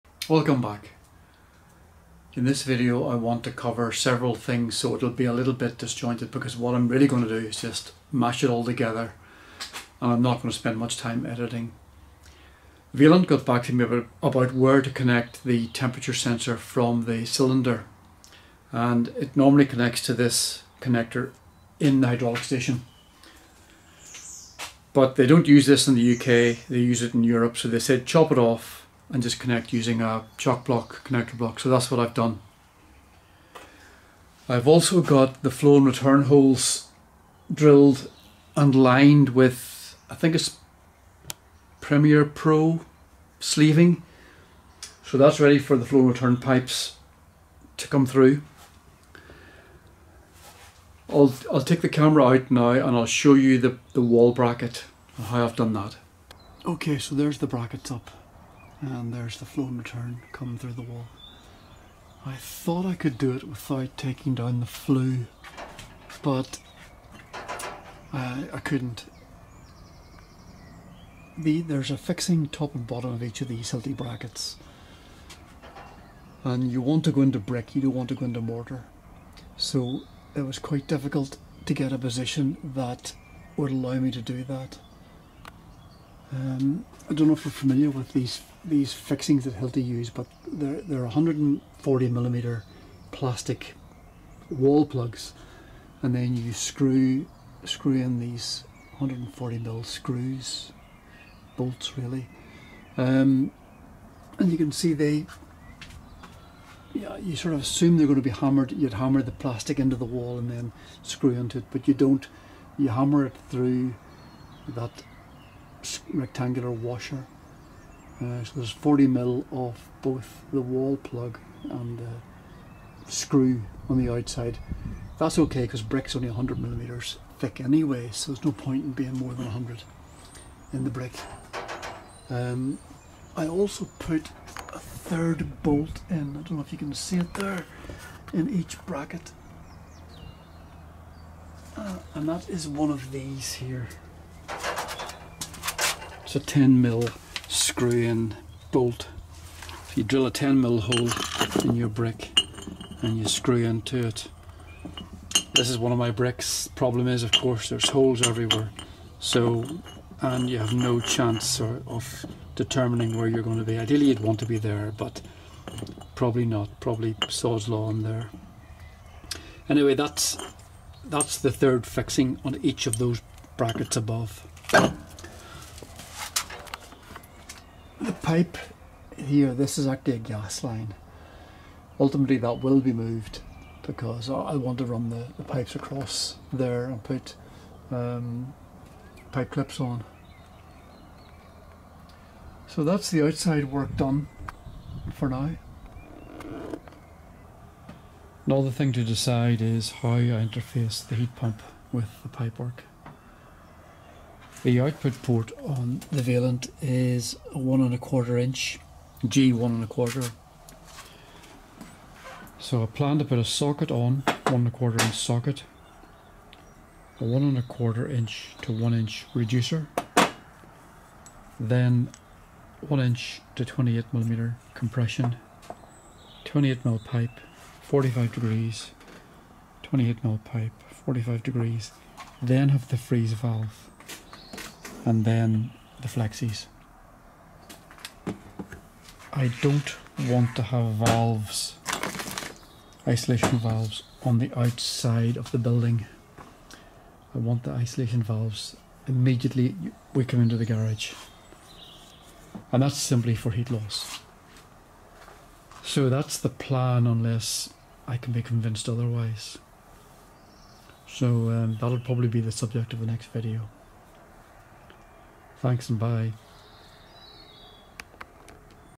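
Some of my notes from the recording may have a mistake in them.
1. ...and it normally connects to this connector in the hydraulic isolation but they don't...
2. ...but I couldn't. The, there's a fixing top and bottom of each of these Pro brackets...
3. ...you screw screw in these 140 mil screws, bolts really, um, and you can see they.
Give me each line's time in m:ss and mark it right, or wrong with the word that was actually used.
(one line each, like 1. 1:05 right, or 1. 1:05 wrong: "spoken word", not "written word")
1. 0:18 wrong: "station", not "isolation"
2. 1:06 wrong: "Hilti", not "Pro"
3. 1:36 right.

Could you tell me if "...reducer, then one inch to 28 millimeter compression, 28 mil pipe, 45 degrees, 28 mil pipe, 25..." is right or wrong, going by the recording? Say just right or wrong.
wrong.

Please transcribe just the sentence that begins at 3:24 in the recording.
The output port on the Vaillant is one and a quarter inch, G one and a quarter.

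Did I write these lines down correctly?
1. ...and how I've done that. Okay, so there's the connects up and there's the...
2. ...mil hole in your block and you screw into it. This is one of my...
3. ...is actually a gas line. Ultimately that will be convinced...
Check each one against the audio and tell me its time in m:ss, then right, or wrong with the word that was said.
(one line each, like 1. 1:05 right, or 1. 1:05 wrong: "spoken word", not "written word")
1. 0:55 wrong: "brackets", not "connects"
2. 2:30 wrong: "brick", not "block"
3. 2:59 wrong: "moved", not "convinced".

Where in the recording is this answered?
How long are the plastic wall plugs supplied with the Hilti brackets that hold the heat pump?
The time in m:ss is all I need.
1:31.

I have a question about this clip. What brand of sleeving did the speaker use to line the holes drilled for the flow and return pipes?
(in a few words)
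Premier Pro.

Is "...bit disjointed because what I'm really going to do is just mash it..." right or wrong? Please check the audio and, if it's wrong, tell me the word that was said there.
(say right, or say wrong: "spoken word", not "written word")
right.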